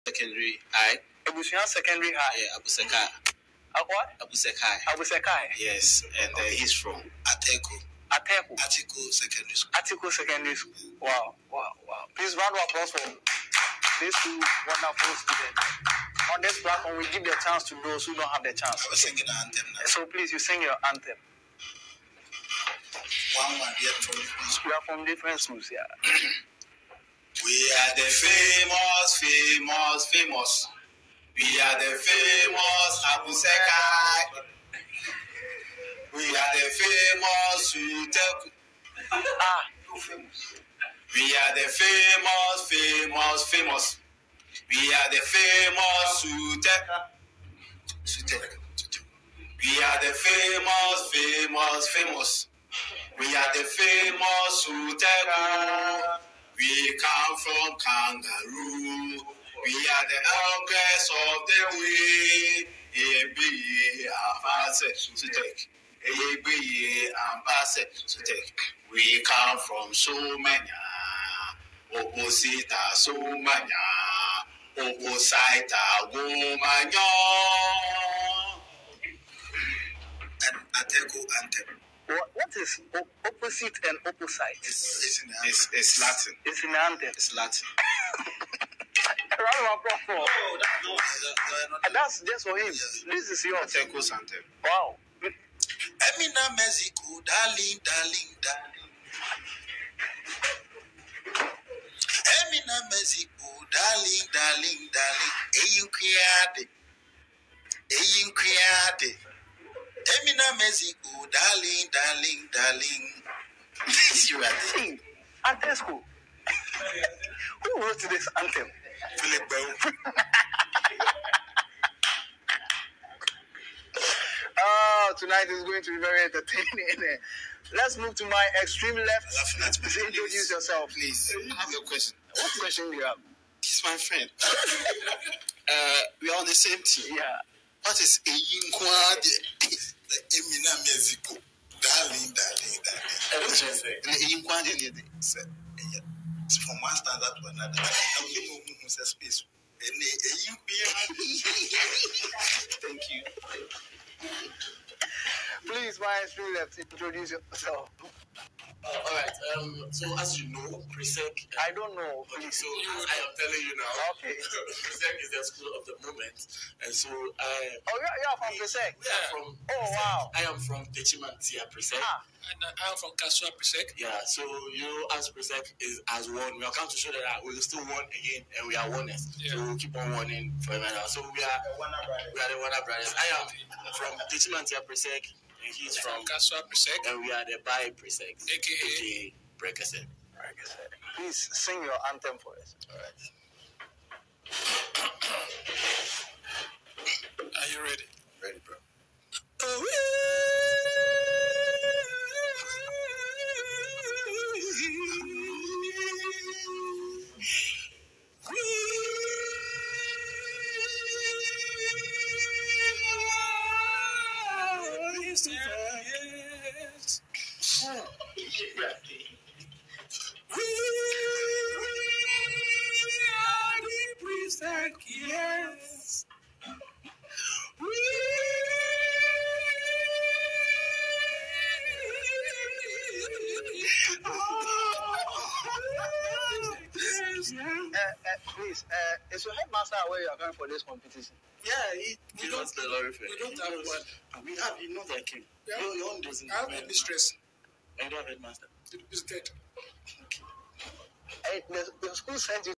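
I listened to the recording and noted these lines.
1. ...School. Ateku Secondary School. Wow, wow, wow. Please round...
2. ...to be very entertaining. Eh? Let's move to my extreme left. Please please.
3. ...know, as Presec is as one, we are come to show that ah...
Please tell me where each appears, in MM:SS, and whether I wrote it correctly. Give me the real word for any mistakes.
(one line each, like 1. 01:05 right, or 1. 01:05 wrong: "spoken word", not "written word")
1. 00:09 right
2. 02:05 right
3. 02:54 right.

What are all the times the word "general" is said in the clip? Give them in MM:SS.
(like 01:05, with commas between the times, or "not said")
not said.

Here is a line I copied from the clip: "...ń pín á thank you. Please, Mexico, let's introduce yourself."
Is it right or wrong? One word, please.
wrong.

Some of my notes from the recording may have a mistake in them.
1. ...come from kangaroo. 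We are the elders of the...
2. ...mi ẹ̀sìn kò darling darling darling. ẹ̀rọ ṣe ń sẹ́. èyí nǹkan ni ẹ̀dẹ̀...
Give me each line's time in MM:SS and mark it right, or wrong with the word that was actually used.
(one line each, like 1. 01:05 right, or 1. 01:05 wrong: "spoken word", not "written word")
1. 00:56 right
2. 02:20 right.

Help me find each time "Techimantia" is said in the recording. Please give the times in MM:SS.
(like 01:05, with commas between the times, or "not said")
02:50, 03:04.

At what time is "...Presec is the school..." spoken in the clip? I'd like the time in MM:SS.
02:44.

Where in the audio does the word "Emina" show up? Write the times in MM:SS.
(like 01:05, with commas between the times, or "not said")
01:35, 01:41, 01:50.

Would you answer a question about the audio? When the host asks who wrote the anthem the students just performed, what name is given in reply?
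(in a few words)
Philip Bell.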